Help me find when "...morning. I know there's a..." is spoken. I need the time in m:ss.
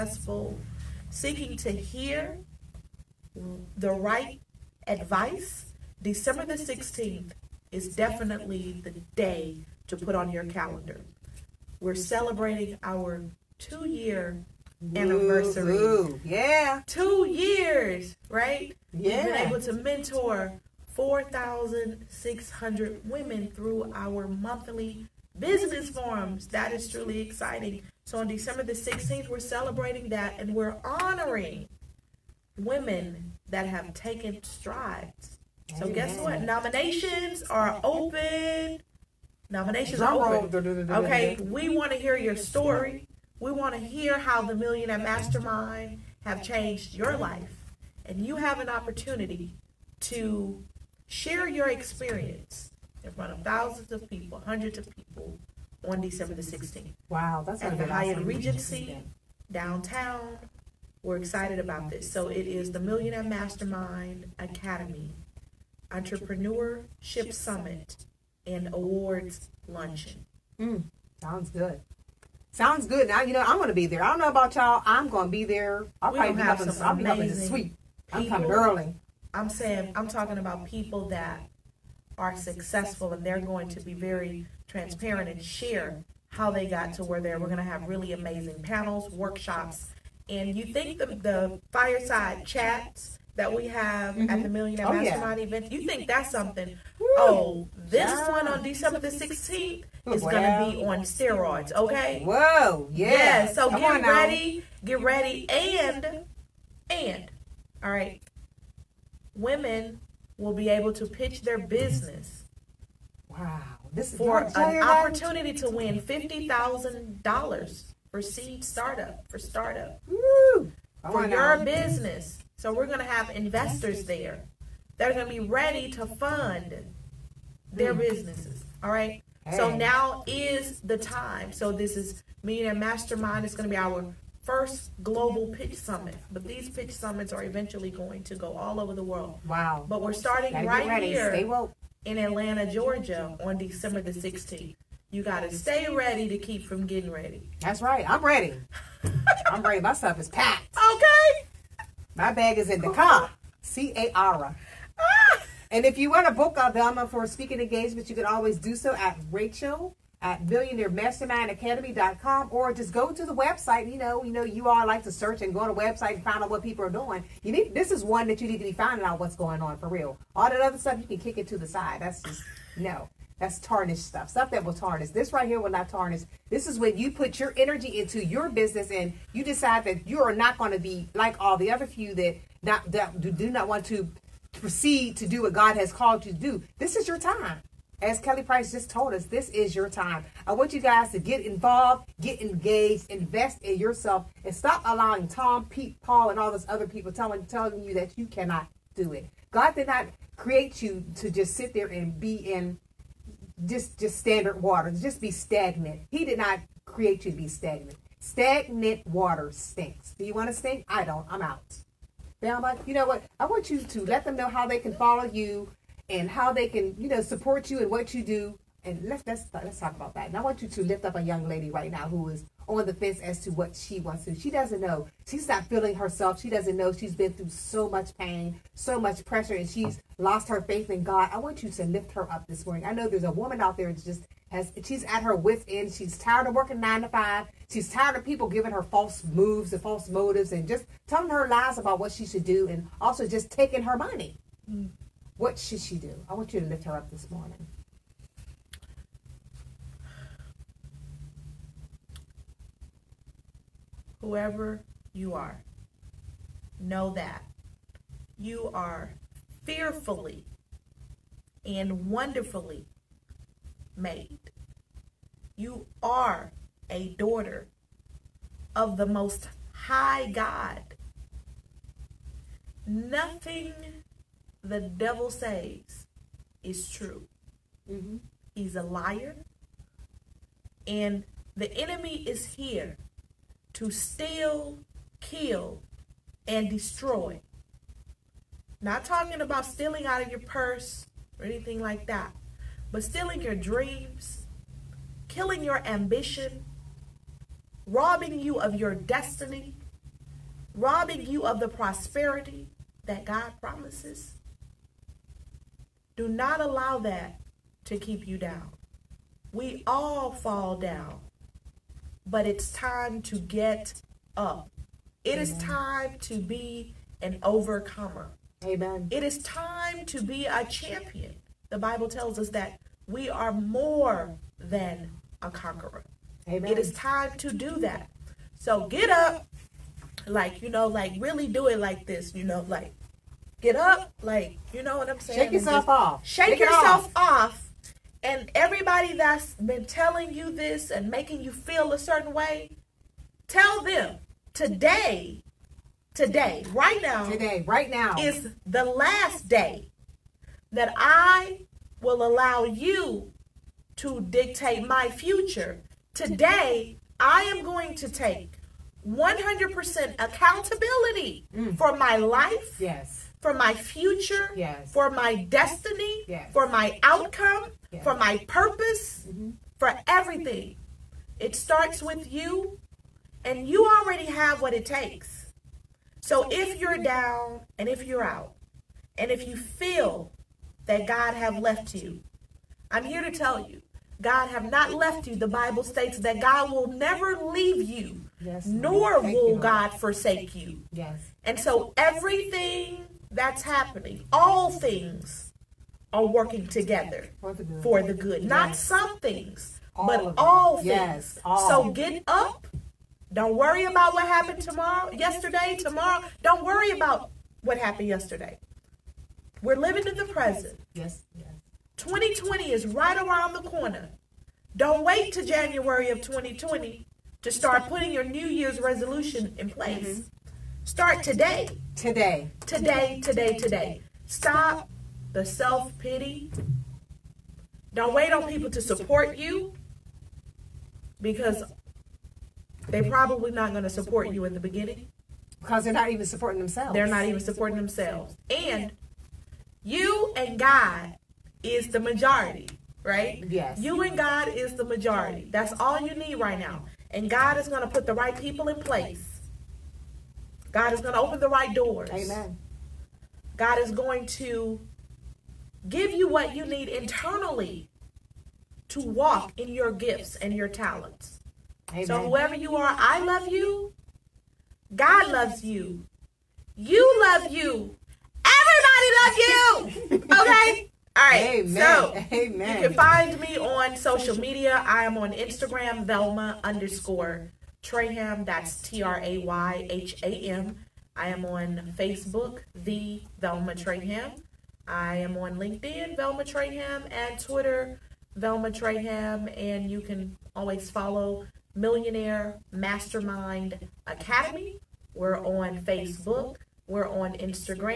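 3:52.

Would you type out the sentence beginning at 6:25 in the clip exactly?
The Bible states that God will never leave you, yes, nor will God forsake you.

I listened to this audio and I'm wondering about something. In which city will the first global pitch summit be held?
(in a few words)
Atlanta, Georgia.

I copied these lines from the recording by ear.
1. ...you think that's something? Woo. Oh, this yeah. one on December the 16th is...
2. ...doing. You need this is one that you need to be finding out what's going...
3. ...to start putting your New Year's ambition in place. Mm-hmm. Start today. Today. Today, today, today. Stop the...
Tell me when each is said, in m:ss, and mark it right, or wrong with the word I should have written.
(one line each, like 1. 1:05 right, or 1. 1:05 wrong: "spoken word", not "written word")
1. 1:35 right
2. 2:46 right
3. 6:57 wrong: "resolution", not "ambition".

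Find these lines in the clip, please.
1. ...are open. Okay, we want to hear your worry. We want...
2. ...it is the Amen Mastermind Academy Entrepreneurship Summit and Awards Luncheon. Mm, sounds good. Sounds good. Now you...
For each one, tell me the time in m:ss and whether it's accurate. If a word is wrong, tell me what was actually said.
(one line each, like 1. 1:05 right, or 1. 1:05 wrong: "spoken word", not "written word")
1. 0:40 wrong: "story", not "worry"
2. 1:02 wrong: "Millionaire", not "Amen".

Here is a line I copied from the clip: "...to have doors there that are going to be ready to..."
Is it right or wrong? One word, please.
wrong.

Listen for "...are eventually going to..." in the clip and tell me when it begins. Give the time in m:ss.
2:17.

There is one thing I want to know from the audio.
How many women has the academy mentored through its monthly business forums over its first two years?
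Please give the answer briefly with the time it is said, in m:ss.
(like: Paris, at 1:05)
4,600, at 0:20.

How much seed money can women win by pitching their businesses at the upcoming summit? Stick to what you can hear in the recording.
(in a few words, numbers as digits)
$50,000.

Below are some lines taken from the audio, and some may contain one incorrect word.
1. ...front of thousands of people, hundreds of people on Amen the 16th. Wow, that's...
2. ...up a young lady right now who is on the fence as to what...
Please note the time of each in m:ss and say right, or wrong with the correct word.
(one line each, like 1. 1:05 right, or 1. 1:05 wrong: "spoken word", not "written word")
1. 0:53 wrong: "December", not "Amen"
2. 3:41 right.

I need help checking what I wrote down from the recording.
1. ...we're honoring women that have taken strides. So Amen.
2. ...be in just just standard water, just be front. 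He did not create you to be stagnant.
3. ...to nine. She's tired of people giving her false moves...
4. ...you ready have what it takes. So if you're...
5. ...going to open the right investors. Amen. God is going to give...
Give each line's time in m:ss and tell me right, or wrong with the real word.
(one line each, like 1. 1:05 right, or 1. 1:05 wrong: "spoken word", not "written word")
1. 0:30 right
2. 3:22 wrong: "stagnant", not "front"
3. 3:57 wrong: "five", not "nine"
4. 6:13 wrong: "already", not "ready"
5. 7:31 wrong: "doors", not "investors".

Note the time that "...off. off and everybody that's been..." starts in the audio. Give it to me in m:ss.
5:37.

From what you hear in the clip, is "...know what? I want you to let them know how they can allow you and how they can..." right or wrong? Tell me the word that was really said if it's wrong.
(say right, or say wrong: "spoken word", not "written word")
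wrong: "follow", not "allow".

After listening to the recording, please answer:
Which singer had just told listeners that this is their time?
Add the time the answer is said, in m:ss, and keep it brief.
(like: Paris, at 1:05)
Kelly Price, at 3:08.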